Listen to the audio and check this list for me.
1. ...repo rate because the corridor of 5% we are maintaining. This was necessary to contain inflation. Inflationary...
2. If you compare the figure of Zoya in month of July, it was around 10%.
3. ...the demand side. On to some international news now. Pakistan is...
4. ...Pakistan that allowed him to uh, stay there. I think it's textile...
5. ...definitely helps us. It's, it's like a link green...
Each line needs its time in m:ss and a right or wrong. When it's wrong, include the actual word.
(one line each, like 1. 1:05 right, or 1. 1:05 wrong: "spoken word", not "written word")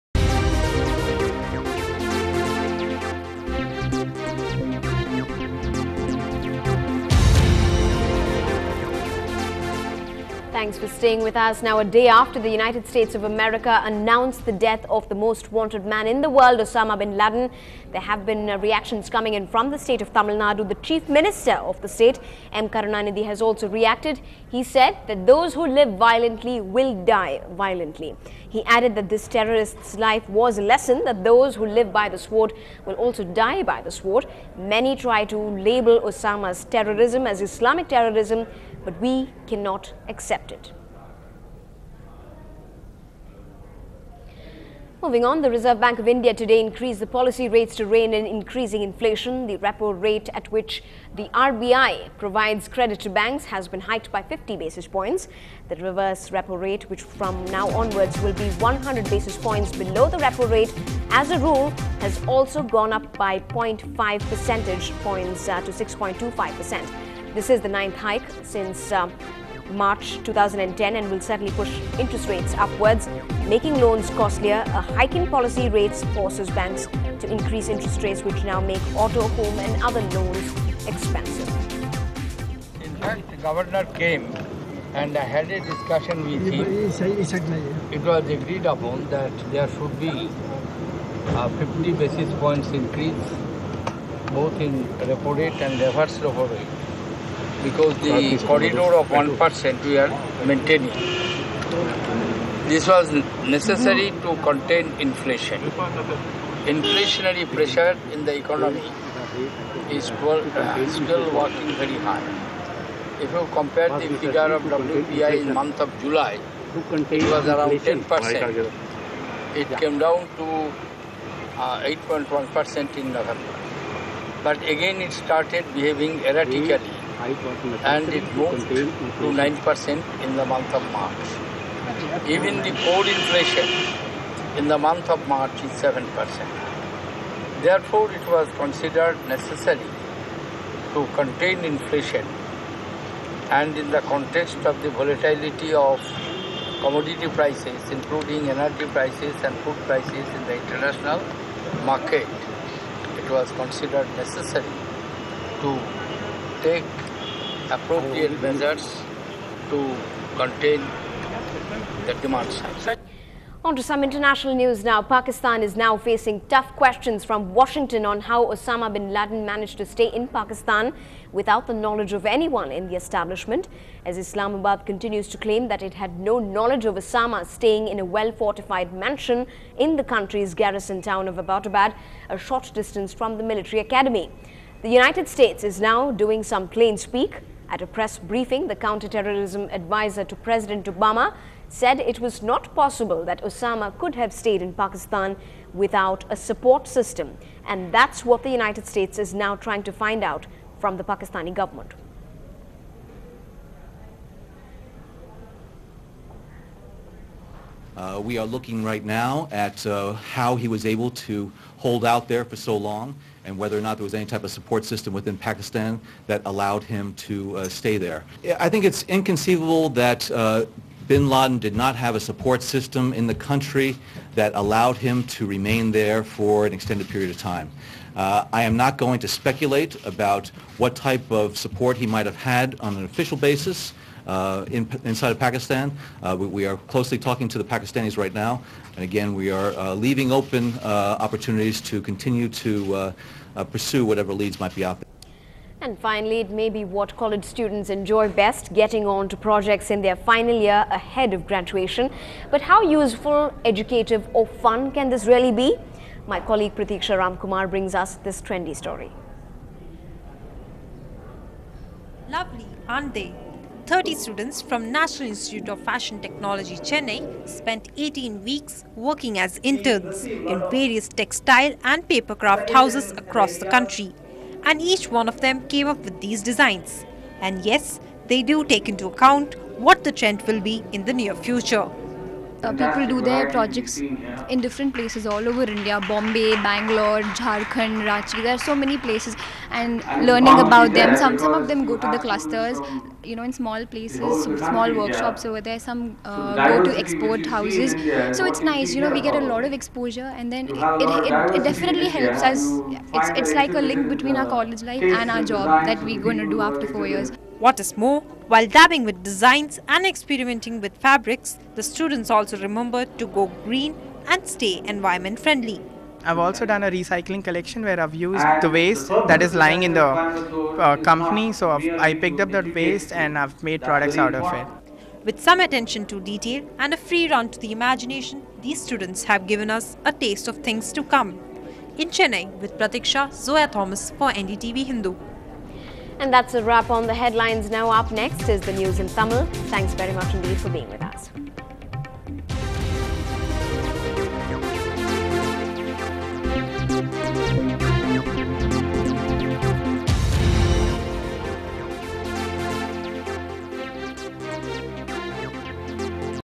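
1. 1:36 wrong: "1", not "5"
2. 1:53 wrong: "WPI", not "Zoya"
3. 2:42 right
4. 3:35 wrong: "inconceivable", not "textile"
5. 5:01 wrong: "between", not "green".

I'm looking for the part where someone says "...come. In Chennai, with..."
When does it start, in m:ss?
5:31.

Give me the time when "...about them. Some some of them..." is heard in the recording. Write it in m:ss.
4:50.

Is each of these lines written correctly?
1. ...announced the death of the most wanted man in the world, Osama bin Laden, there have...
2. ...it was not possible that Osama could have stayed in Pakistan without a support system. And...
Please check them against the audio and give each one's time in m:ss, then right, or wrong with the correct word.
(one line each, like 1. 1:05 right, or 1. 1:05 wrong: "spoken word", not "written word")
1. 0:13 right
2. 3:12 right.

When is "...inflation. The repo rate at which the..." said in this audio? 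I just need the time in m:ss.
0:48.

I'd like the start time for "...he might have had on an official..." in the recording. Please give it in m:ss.
3:51.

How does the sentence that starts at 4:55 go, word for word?
Some uh, go to export houses.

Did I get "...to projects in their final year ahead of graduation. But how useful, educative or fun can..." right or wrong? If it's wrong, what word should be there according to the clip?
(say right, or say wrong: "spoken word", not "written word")
right.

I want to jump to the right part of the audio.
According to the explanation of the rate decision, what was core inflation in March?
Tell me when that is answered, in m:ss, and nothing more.
2:15.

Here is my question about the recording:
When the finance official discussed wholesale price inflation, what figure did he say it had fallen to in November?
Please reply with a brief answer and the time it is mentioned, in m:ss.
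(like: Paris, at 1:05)
8.1%, at 2:01.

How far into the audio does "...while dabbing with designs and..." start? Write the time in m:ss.
5:08.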